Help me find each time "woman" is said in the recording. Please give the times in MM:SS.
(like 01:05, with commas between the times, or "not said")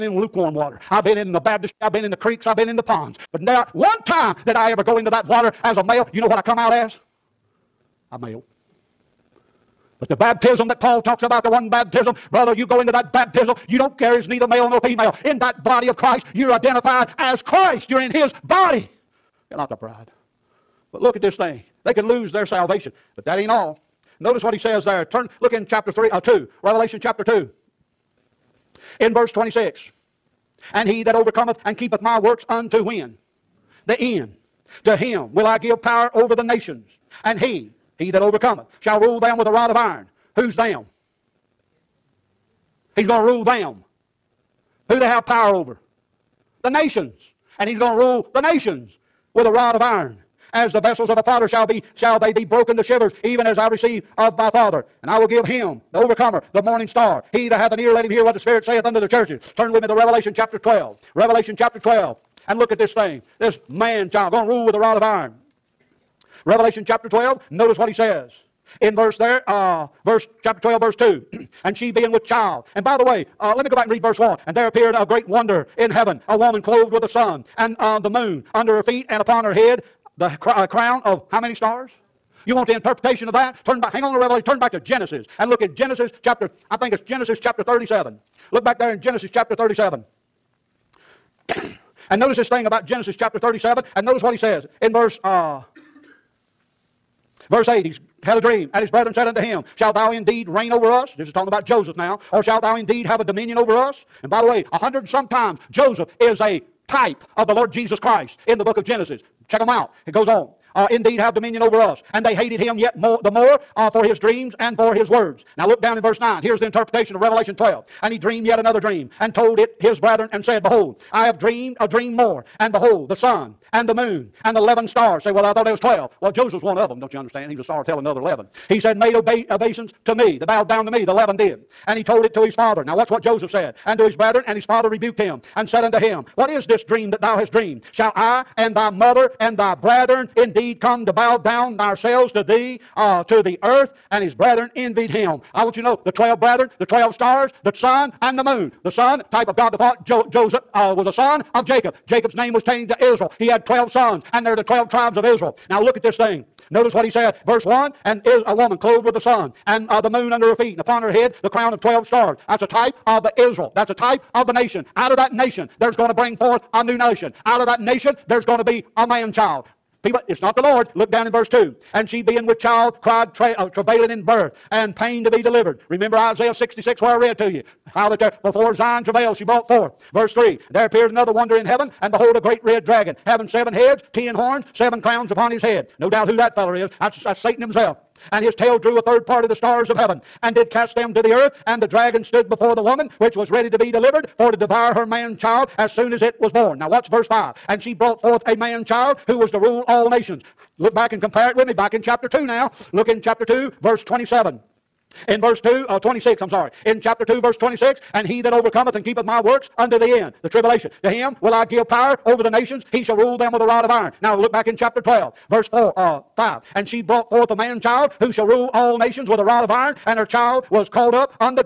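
01:16, 02:38, 03:12.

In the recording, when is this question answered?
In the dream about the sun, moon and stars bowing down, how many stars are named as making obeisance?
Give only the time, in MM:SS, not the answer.
02:04.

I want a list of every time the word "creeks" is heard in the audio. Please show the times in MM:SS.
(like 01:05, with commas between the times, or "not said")
00:02.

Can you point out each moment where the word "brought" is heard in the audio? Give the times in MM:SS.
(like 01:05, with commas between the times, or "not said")
02:59, 03:17, 03:37.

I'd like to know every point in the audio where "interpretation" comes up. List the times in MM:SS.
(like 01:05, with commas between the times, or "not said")
01:22, 01:56.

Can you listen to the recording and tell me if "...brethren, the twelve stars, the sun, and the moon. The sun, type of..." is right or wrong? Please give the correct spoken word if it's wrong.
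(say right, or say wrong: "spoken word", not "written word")
right.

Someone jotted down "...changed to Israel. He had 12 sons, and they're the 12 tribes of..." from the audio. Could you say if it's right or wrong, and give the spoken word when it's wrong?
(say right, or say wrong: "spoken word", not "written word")
right.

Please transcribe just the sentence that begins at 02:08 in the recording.
He said, made obe- obeisance to me.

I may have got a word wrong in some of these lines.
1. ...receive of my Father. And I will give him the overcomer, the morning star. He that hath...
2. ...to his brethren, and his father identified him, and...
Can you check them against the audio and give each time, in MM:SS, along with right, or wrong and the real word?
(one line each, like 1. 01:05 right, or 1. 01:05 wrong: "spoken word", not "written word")
1. 00:53 right
2. 02:13 wrong: "rebuked", not "identified".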